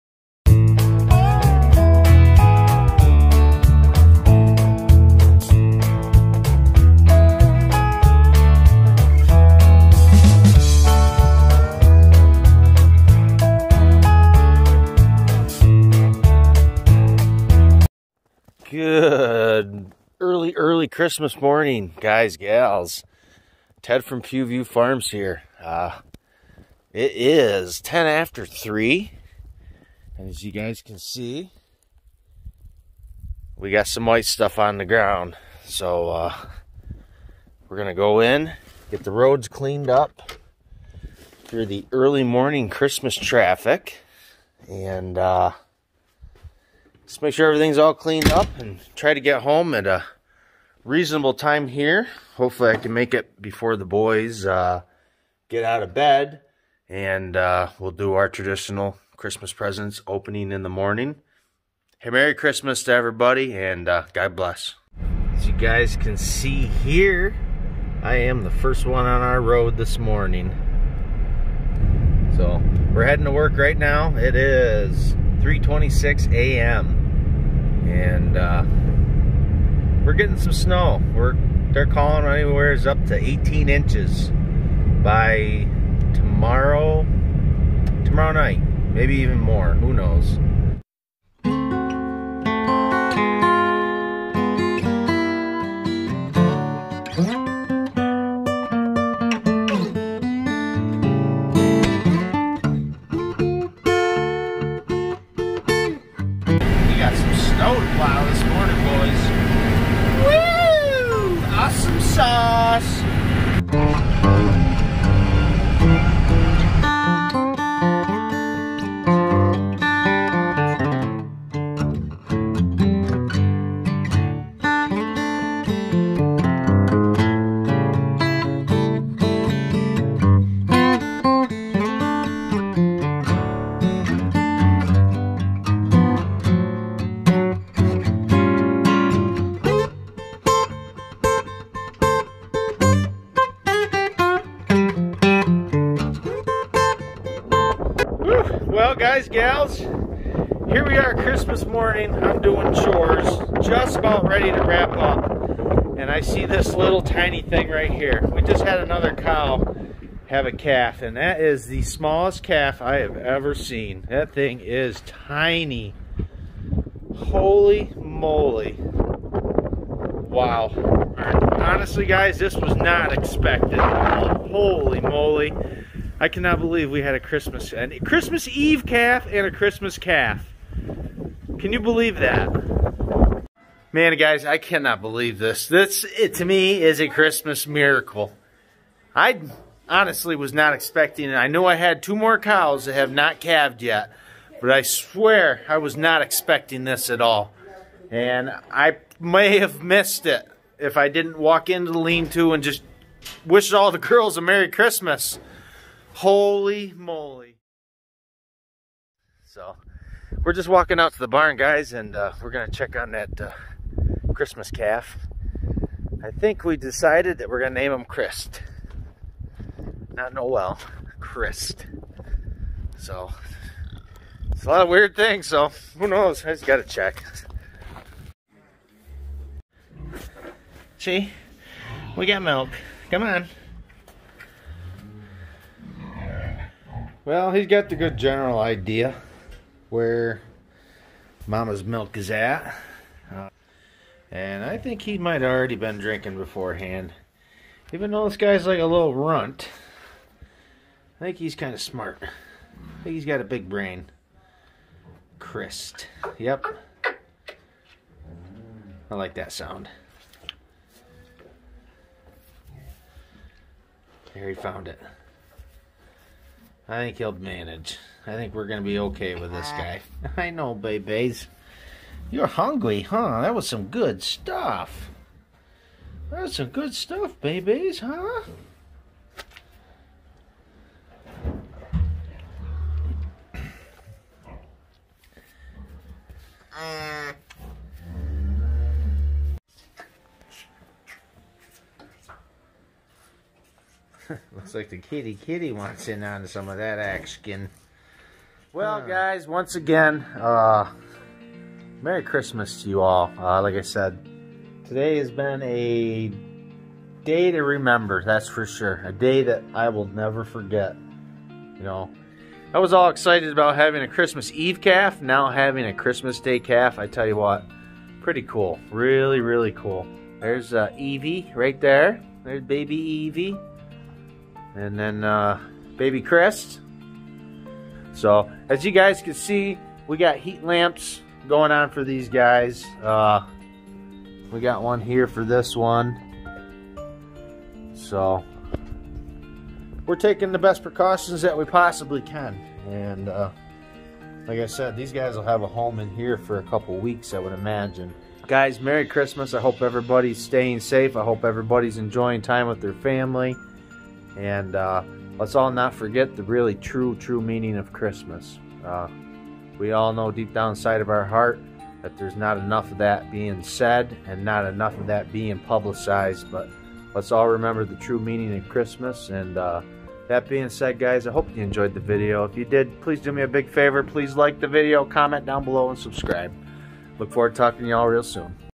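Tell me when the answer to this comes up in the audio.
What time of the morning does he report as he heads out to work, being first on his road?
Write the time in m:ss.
1:15.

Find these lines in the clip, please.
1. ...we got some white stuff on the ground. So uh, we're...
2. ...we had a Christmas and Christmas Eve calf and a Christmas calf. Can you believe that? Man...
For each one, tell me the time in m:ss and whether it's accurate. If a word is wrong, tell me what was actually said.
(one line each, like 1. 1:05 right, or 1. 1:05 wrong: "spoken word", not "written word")
1. 0:33 right
2. 2:56 right.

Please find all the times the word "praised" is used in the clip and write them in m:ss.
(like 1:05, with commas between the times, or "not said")
not said.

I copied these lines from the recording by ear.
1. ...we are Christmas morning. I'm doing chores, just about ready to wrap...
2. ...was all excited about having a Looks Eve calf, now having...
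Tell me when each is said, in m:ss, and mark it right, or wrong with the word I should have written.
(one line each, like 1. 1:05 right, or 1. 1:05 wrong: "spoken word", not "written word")
1. 2:30 right
2. 5:12 wrong: "Christmas", not "Looks".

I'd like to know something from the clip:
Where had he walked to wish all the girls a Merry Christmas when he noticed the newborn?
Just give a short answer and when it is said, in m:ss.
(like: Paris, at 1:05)
the lean-to, at 3:21.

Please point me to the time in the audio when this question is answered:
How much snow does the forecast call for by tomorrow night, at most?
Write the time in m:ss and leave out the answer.
1:23.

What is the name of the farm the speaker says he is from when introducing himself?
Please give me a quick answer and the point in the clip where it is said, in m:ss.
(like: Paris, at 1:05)
Pughview Farms, at 0:24.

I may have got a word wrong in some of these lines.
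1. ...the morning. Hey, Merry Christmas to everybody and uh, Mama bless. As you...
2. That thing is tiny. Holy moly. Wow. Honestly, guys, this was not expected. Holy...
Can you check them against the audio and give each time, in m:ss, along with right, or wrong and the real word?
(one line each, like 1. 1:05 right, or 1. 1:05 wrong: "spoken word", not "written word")
1. 1:00 wrong: "God", not "Mama"
2. 2:44 right.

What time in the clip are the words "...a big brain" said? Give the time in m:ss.
4:13.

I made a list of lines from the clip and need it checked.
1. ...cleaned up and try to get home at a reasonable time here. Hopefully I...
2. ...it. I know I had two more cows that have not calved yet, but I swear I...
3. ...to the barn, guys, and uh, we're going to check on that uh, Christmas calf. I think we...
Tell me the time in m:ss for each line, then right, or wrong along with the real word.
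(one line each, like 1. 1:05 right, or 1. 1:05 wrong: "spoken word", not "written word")
1. 0:47 right
2. 3:11 right
3. 3:31 right.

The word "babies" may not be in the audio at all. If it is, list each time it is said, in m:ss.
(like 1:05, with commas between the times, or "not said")
4:30, 4:37.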